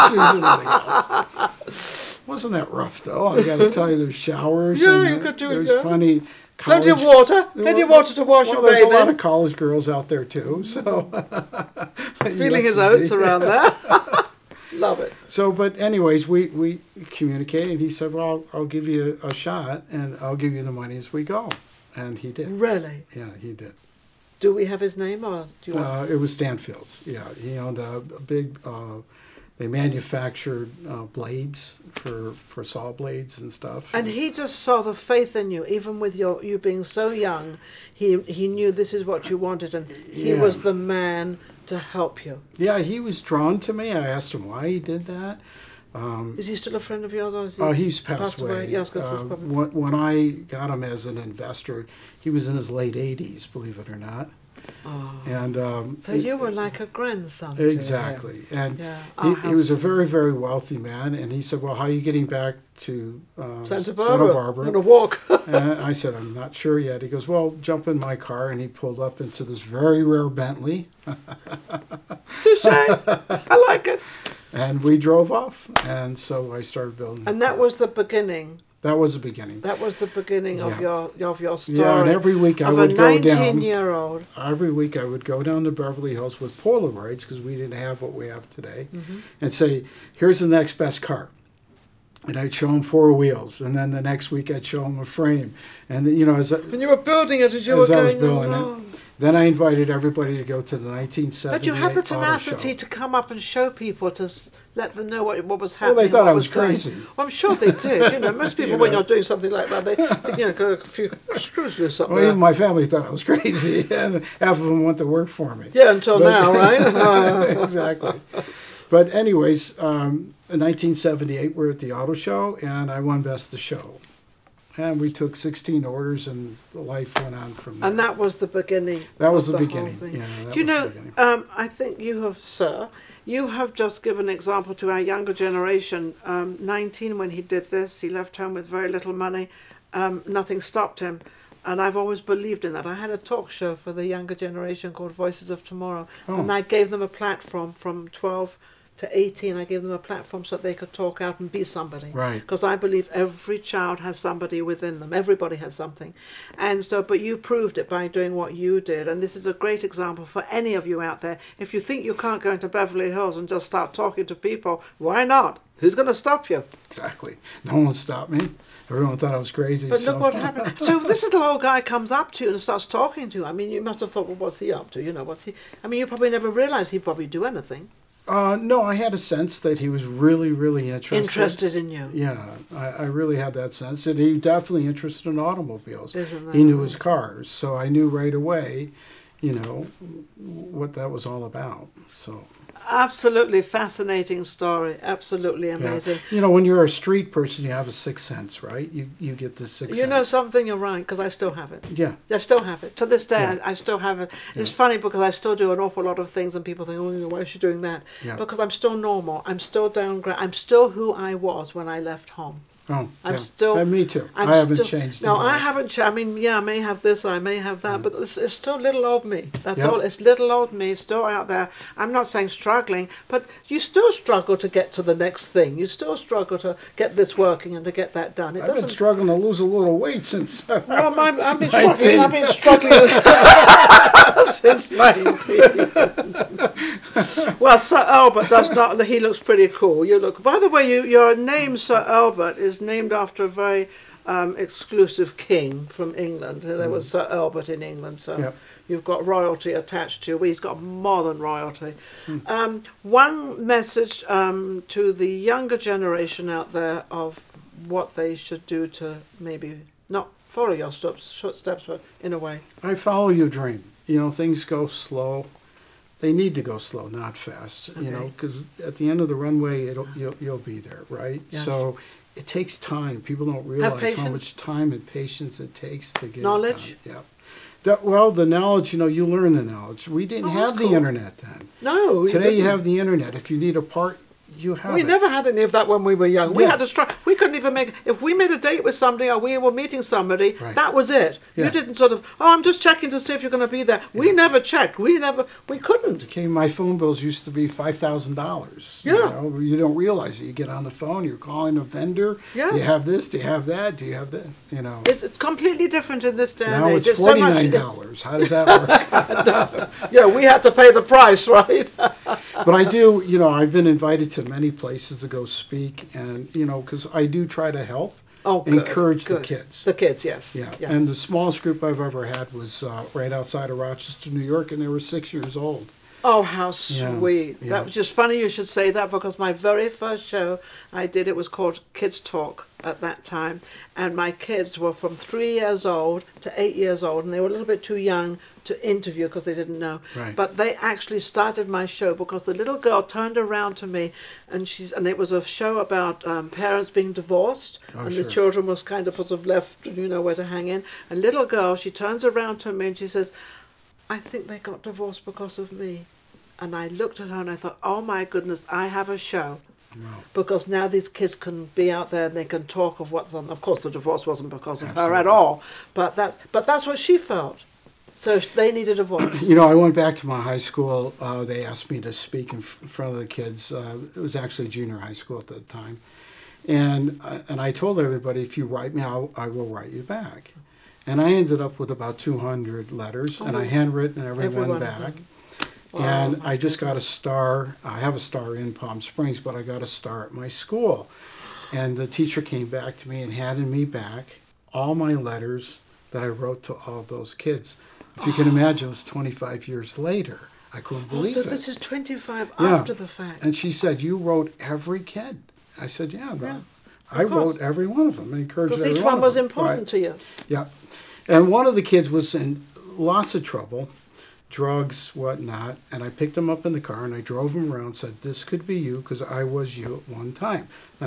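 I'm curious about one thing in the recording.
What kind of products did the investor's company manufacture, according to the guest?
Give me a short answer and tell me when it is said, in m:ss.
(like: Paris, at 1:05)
Saw blades, at 0:32.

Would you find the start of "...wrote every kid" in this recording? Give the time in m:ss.
6:44.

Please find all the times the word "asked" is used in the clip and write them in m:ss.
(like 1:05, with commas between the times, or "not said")
0:44, 6:11.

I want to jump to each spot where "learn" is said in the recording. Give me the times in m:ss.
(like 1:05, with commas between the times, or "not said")
4:39.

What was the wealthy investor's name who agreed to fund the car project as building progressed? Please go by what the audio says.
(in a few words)
Stanfield.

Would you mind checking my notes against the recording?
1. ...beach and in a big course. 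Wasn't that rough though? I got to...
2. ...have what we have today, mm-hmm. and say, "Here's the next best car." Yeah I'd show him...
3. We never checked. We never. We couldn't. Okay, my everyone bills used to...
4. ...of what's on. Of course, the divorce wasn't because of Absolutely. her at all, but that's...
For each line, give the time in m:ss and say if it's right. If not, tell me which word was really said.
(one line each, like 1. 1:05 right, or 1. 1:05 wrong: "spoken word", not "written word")
1. 0:00 wrong: "house", not "course"
2. 1:27 wrong: "And", not "Yeah"
3. 4:54 wrong: "phone", not "everyone"
4. 6:02 right.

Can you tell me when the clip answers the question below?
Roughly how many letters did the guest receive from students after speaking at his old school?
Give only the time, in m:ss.
6:21.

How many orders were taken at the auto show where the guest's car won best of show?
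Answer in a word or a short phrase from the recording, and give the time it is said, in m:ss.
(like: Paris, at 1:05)
16, at 2:05.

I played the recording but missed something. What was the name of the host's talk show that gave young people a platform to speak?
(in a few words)
Voices of Tomorrow.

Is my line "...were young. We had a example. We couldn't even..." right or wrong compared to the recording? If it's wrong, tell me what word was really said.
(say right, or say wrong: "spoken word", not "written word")
wrong: "struggle", not "example".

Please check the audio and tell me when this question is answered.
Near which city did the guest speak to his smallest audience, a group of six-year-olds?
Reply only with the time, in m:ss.
5:23.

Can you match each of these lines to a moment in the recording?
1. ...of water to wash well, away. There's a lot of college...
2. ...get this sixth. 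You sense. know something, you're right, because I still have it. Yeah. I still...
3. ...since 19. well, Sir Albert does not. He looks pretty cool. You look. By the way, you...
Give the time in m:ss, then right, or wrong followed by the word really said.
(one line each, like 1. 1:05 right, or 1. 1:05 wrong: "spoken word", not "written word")
1. 0:07 right
2. 3:19 right
3. 3:57 right.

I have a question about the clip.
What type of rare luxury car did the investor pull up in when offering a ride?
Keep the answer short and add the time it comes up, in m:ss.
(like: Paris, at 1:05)
Bentley, at 1:10.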